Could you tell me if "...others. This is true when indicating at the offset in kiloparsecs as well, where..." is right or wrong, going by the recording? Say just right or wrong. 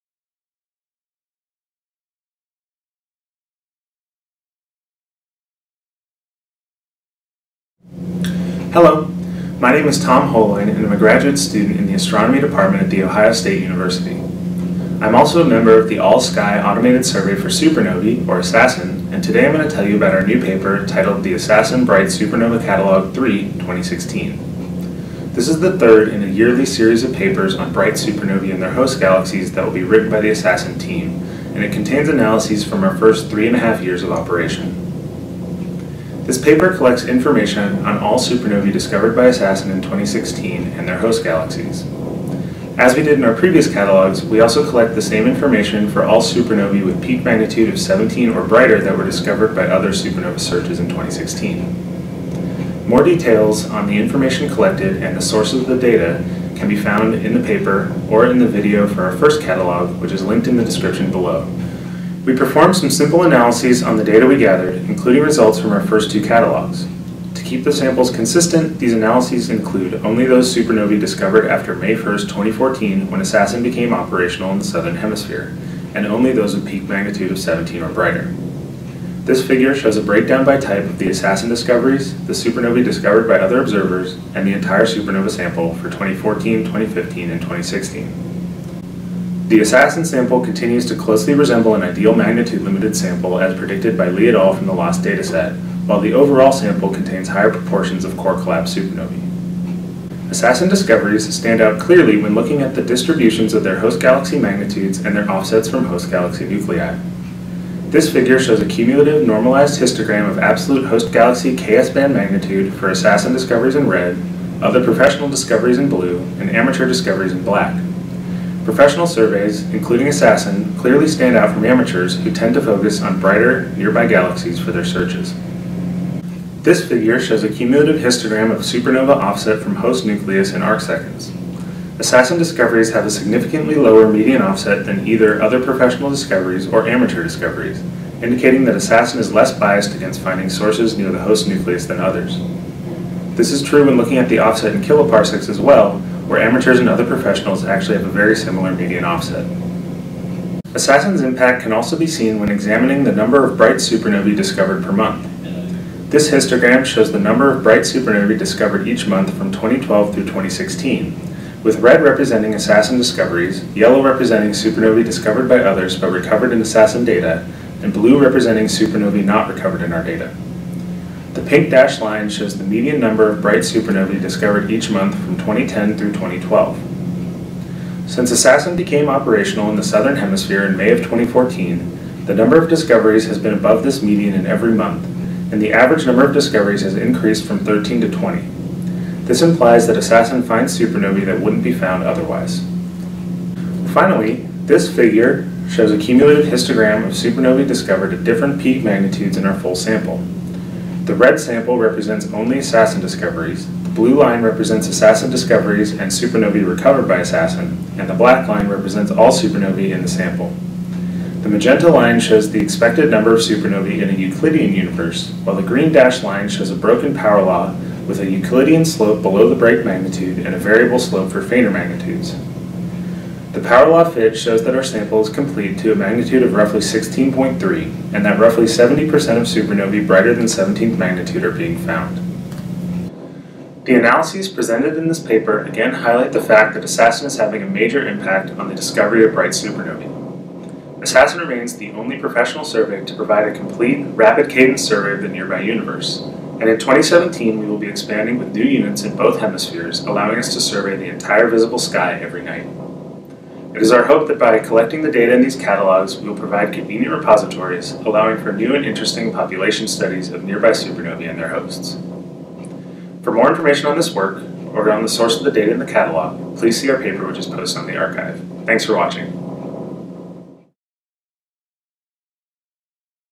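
wrong.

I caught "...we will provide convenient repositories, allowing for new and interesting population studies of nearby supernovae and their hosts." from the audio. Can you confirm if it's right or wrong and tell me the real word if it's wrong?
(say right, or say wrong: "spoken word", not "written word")
right.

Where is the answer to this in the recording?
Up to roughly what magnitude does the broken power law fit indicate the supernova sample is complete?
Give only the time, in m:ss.
3:46.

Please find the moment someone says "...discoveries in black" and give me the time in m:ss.
1:56.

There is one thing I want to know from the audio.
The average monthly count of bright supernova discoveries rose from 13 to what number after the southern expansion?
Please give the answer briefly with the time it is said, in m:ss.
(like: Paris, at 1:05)
20, at 3:08.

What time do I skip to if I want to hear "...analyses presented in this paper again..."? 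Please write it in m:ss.
3:53.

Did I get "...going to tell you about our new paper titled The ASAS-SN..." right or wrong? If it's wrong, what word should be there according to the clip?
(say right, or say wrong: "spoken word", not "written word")
right.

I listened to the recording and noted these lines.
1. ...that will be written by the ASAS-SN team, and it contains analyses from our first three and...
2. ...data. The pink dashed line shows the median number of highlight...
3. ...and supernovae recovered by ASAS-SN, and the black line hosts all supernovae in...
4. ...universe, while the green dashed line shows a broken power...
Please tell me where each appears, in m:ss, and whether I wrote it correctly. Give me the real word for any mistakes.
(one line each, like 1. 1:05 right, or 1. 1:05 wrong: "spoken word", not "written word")
1. 0:29 right
2. 2:50 wrong: "bright", not "highlight"
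3. 3:25 wrong: "represents", not "hosts"
4. 3:34 right.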